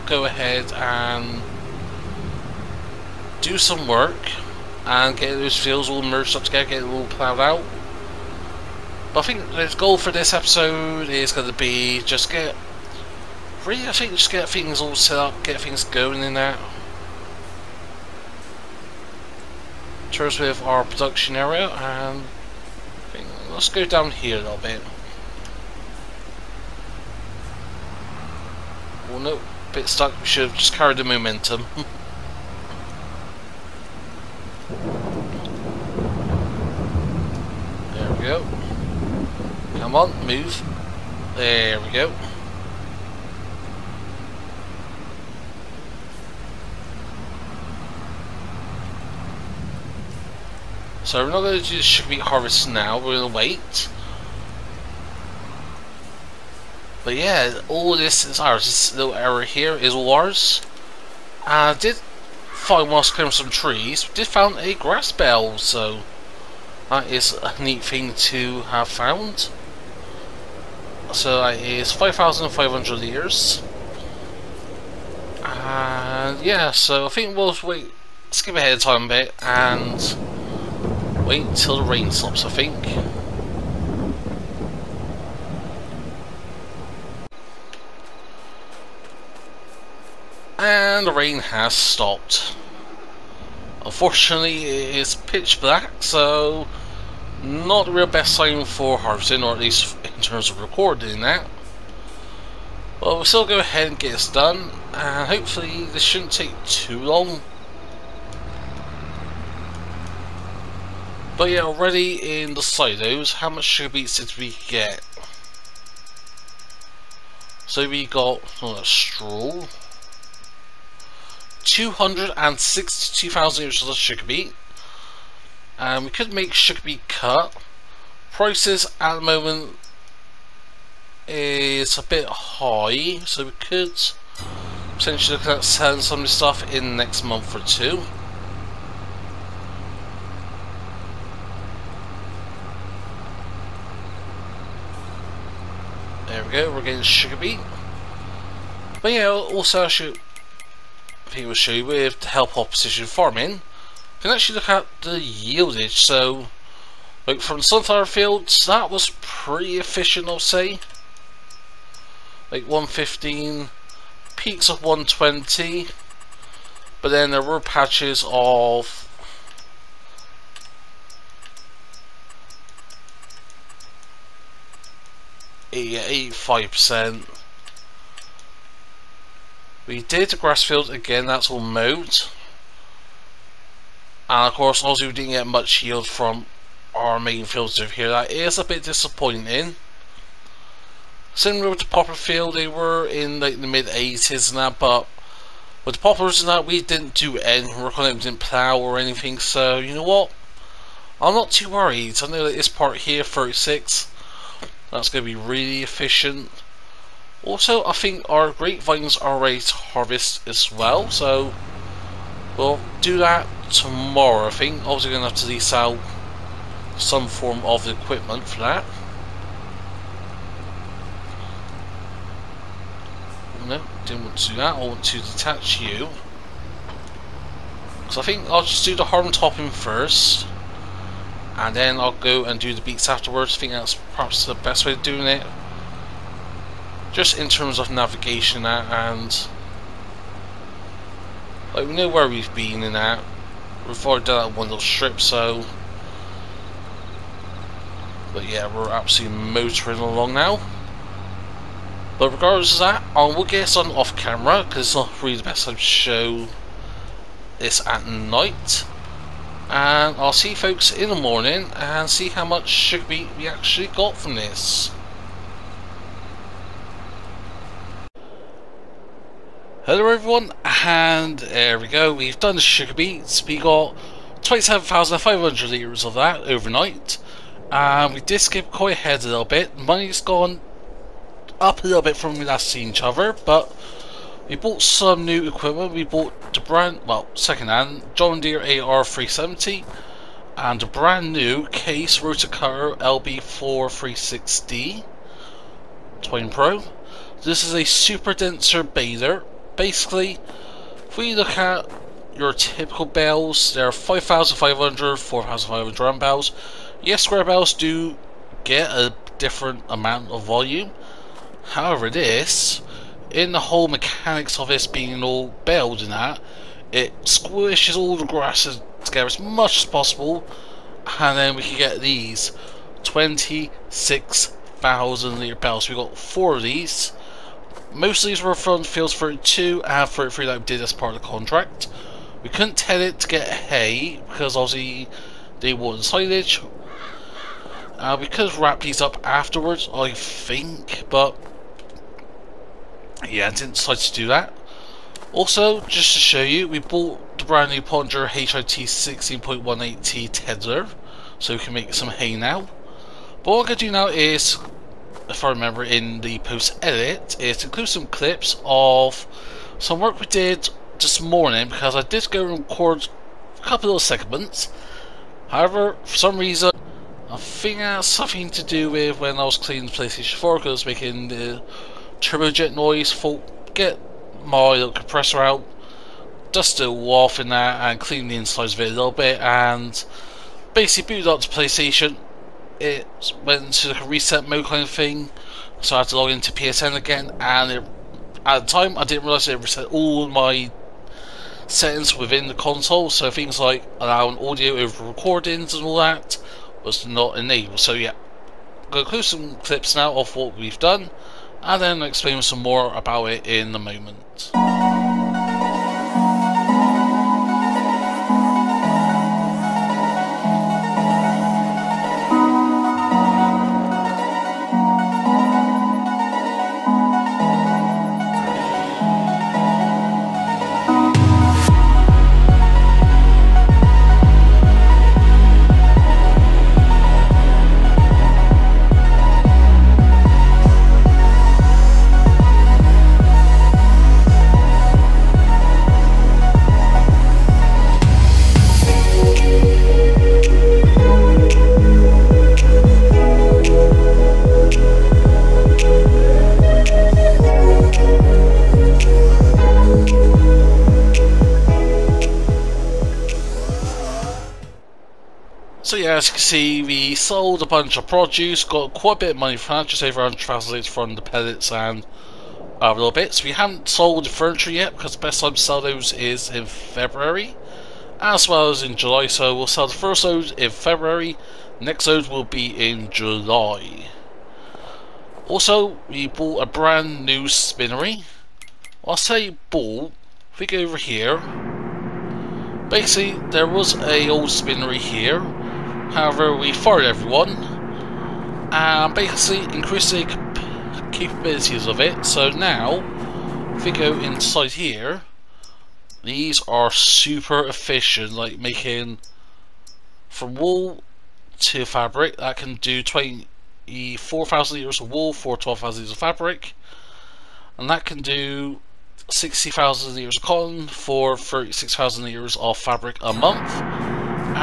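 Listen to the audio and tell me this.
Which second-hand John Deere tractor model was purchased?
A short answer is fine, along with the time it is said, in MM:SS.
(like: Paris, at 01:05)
8R370, at 04:48.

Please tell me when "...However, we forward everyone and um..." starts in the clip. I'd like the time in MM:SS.
08:06.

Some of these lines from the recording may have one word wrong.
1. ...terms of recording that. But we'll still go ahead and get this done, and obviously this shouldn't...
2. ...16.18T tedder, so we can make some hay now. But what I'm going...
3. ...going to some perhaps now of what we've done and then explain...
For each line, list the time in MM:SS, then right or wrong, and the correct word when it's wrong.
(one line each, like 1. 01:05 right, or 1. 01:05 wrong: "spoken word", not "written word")
1. 01:40 wrong: "hopefully", not "obviously"
2. 05:48 right
3. 06:39 wrong: "clips", not "perhaps".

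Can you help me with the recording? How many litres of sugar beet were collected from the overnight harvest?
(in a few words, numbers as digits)
27,500 litres.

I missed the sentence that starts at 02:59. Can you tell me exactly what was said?
We did the grass field again, that's all mowed.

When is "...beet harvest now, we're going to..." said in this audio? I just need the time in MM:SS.
00:52.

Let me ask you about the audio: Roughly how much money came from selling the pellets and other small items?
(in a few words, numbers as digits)
just over 100,000.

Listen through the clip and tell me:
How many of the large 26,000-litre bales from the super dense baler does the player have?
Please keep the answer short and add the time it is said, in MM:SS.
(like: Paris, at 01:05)
four, at 05:26.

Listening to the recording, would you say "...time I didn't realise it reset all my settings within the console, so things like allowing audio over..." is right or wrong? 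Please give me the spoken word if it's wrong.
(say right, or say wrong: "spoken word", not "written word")
right.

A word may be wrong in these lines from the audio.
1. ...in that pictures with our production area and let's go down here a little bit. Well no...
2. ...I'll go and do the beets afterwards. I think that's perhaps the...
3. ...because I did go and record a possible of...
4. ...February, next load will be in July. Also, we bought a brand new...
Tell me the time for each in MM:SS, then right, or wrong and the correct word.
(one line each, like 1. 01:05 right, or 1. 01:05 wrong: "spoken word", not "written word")
1. 00:16 right
2. 03:51 wrong: "beats", not "beets"
3. 06:01 wrong: "couple", not "possible"
4. 07:50 right.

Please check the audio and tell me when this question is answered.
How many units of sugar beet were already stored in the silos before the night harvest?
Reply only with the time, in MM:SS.
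02:01.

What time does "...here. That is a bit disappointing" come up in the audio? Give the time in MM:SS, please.
03:07.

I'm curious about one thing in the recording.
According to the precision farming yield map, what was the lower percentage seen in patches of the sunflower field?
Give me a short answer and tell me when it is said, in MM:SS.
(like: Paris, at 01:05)
85%, at 02:55.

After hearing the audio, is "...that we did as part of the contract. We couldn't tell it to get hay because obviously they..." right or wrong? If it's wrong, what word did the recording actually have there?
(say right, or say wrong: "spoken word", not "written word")
right.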